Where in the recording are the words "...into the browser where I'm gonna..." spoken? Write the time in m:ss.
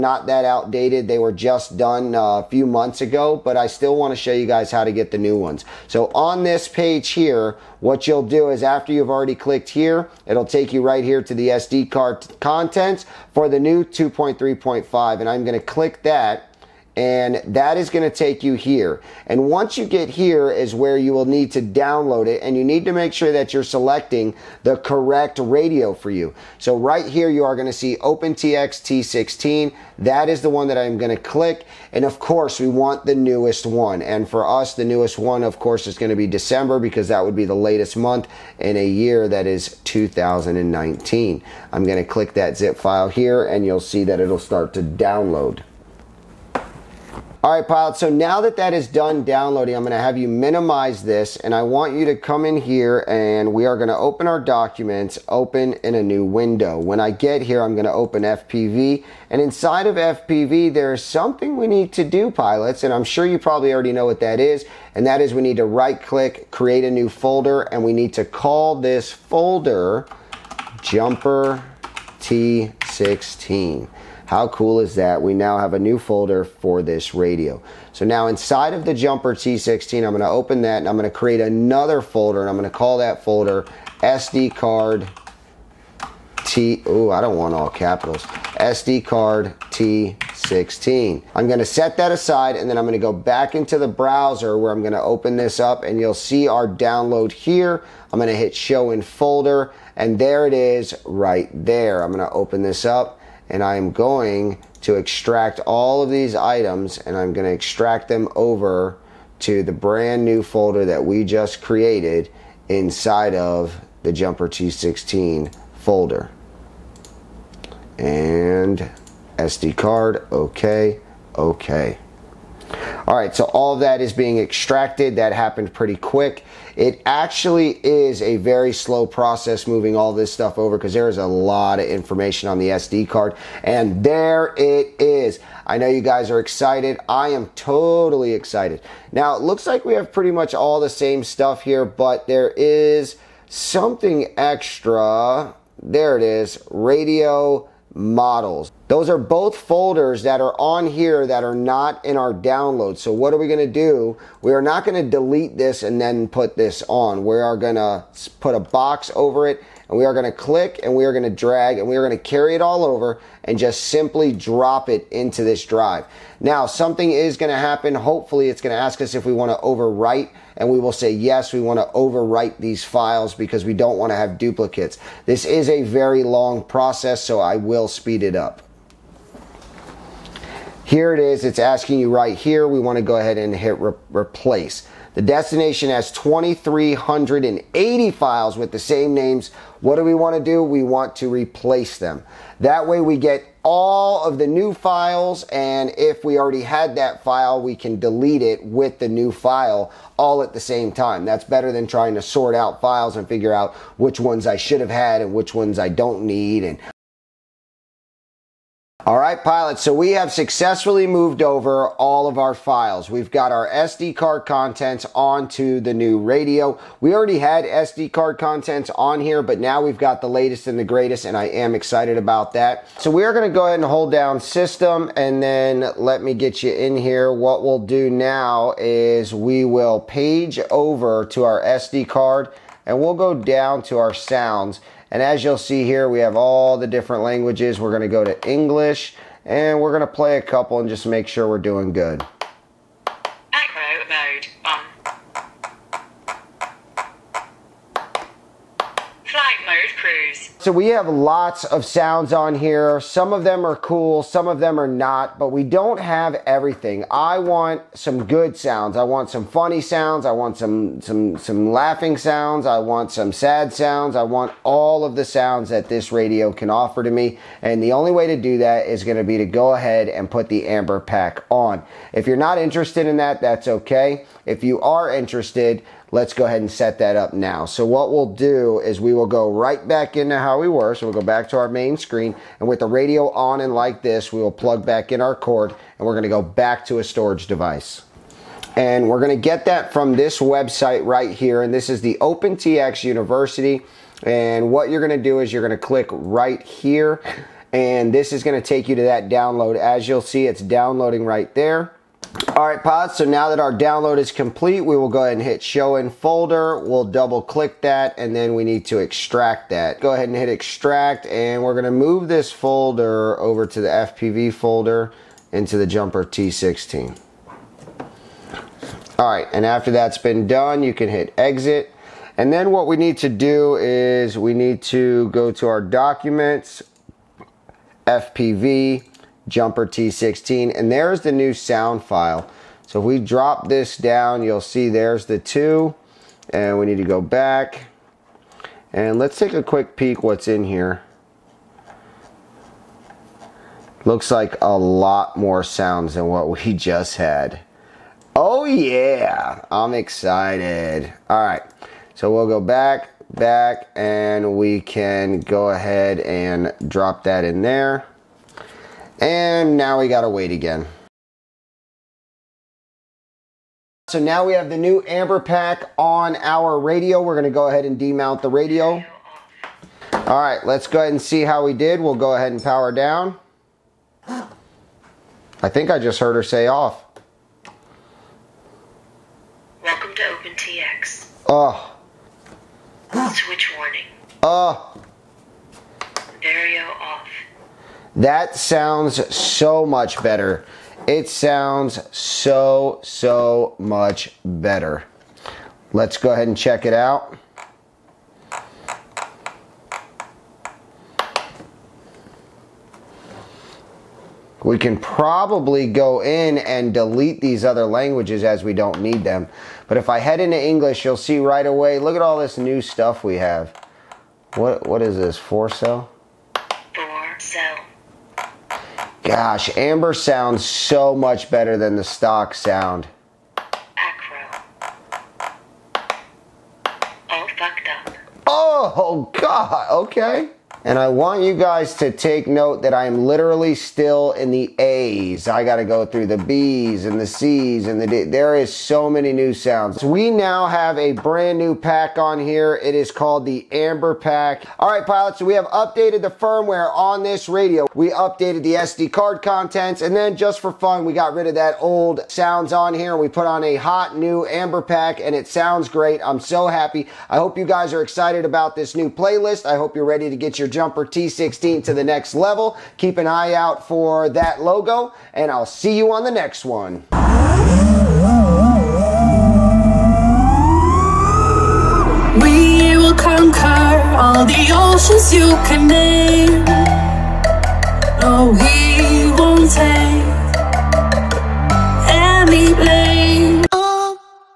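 1:33.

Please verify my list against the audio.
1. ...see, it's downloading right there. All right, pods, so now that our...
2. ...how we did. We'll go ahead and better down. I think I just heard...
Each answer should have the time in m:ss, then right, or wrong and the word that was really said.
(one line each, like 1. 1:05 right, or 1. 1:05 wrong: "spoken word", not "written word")
1. 5:00 right
2. 6:11 wrong: "power", not "better".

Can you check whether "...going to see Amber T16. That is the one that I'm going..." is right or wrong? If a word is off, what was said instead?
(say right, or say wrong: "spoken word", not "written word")
wrong: "OpenTX", not "Amber".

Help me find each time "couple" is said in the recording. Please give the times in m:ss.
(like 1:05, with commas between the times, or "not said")
4:00.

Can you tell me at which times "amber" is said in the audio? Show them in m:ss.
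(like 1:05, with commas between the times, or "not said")
4:30, 6:05, 6:59, 7:23, 7:34.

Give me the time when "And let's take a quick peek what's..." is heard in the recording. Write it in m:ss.
5:38.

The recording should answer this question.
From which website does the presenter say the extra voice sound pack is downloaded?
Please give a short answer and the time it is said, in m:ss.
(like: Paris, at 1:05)
OpenTX University, at 4:52.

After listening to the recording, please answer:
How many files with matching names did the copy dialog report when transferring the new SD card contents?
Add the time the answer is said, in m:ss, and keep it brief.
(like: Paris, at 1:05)
2,380, at 3:06.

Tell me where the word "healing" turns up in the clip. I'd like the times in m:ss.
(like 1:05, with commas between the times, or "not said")
not said.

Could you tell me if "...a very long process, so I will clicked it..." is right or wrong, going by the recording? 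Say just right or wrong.
wrong.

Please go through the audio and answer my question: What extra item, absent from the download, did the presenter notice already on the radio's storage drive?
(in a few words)
Radio models.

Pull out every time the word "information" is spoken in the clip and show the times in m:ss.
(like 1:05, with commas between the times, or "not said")
2:11.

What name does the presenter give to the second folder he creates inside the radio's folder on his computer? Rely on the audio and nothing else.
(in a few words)
SD card T16.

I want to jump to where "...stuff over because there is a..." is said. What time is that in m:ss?
2:10.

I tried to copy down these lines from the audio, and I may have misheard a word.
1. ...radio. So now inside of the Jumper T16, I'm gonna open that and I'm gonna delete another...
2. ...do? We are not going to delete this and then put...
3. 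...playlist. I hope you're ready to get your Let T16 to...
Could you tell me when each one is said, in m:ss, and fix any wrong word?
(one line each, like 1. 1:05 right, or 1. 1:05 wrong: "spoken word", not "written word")
1. 1:17 wrong: "create", not "delete"
2. 2:33 right
3. 7:39 wrong: "Jumper", not "Let".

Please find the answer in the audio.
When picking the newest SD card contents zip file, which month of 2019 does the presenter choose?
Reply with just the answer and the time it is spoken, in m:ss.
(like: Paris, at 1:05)
December, at 0:36.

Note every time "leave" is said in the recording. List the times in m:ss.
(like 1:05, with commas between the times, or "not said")
not said.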